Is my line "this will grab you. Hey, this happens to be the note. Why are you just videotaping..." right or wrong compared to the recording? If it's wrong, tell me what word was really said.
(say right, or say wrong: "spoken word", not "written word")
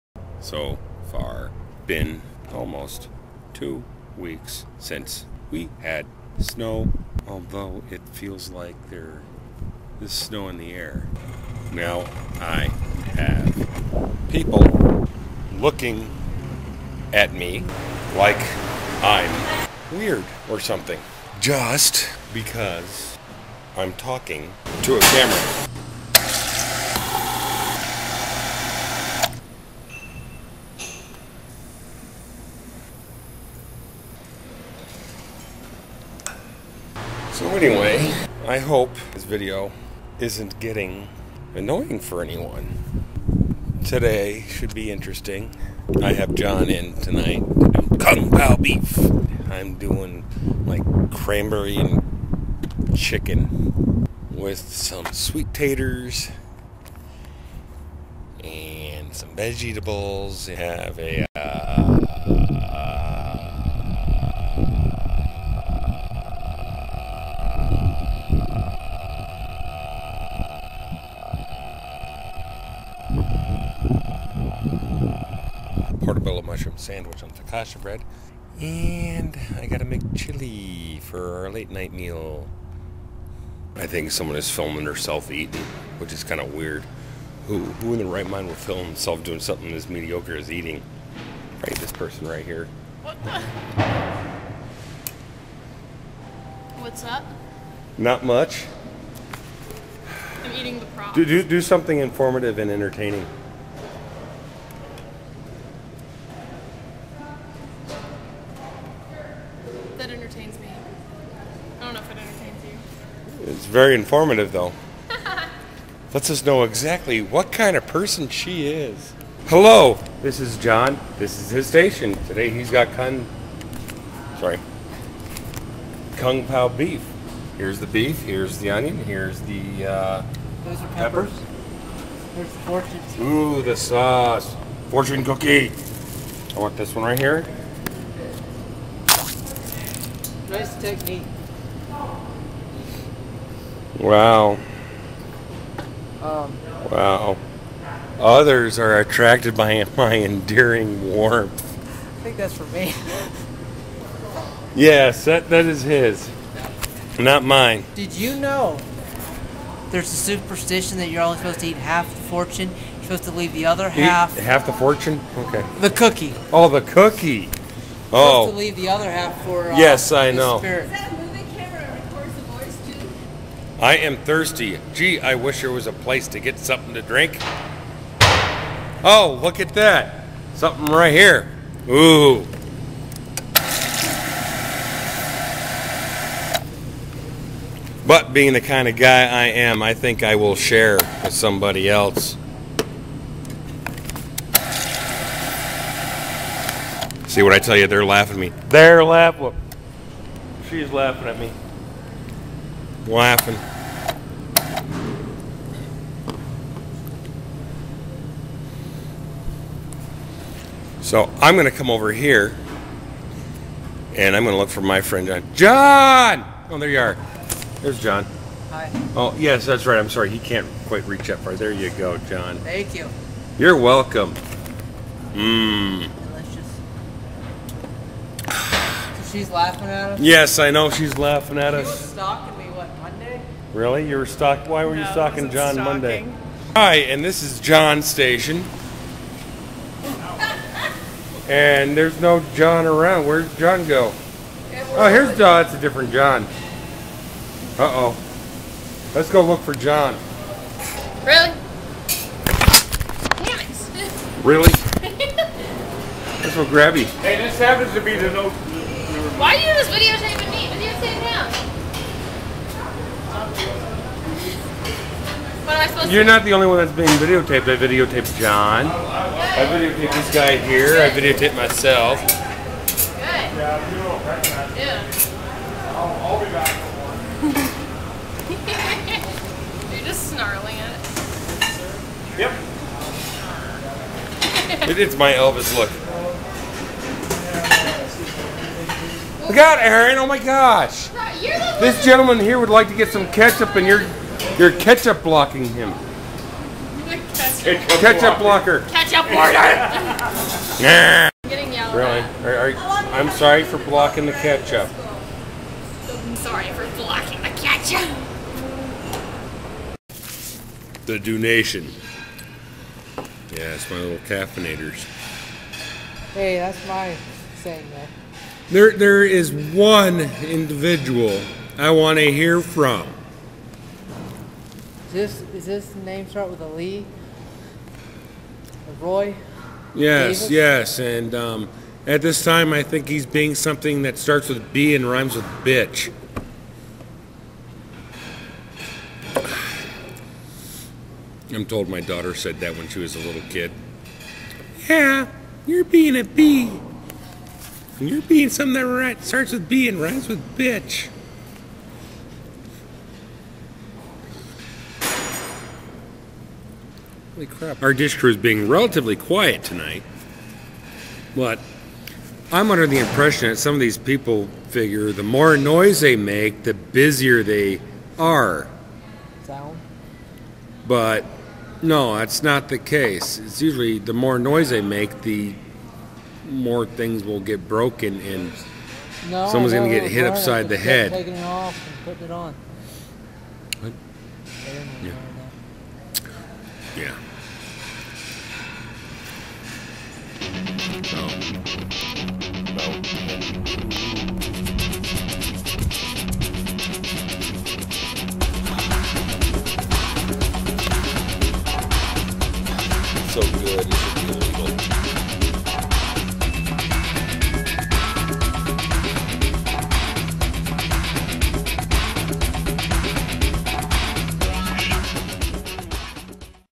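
right.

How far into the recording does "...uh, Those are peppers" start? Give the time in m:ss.
2:09.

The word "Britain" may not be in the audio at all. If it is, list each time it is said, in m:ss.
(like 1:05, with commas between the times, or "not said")
not said.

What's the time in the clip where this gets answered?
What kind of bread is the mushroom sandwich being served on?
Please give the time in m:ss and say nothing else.
1:17.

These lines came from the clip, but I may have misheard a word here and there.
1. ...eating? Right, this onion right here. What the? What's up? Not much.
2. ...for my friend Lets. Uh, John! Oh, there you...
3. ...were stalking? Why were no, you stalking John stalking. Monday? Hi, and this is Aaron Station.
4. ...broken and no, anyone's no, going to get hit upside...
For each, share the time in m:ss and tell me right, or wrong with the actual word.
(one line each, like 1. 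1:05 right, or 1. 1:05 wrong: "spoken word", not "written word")
1. 1:30 wrong: "person", not "onion"
2. 3:34 wrong: "John", not "Lets"
3. 3:54 wrong: "John", not "Aaron"
4. 6:17 wrong: "someone", not "anyone".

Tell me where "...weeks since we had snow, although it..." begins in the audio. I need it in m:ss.
0:04.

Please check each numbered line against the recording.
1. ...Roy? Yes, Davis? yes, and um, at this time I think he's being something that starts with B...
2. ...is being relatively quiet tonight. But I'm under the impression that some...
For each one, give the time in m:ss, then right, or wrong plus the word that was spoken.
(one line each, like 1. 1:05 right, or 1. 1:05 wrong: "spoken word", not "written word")
1. 5:29 right
2. 5:58 right.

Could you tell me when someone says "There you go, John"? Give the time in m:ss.
3:41.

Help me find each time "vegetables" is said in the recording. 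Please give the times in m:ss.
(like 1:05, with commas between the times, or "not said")
0:59.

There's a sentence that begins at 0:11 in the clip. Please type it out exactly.
Now I have people looking at me like I'm weird or something.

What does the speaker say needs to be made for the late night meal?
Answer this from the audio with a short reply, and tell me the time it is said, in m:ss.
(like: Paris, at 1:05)
chili, at 1:20.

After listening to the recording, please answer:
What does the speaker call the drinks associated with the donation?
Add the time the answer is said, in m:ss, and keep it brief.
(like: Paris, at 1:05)
caffeinators, at 5:14.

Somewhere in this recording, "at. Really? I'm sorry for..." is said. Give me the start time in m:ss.
5:02.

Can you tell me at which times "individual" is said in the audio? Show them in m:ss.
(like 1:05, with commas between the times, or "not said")
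5:20.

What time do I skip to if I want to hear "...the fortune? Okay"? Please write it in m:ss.
2:44.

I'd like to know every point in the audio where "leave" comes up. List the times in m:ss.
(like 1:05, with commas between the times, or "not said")
2:43, 2:48.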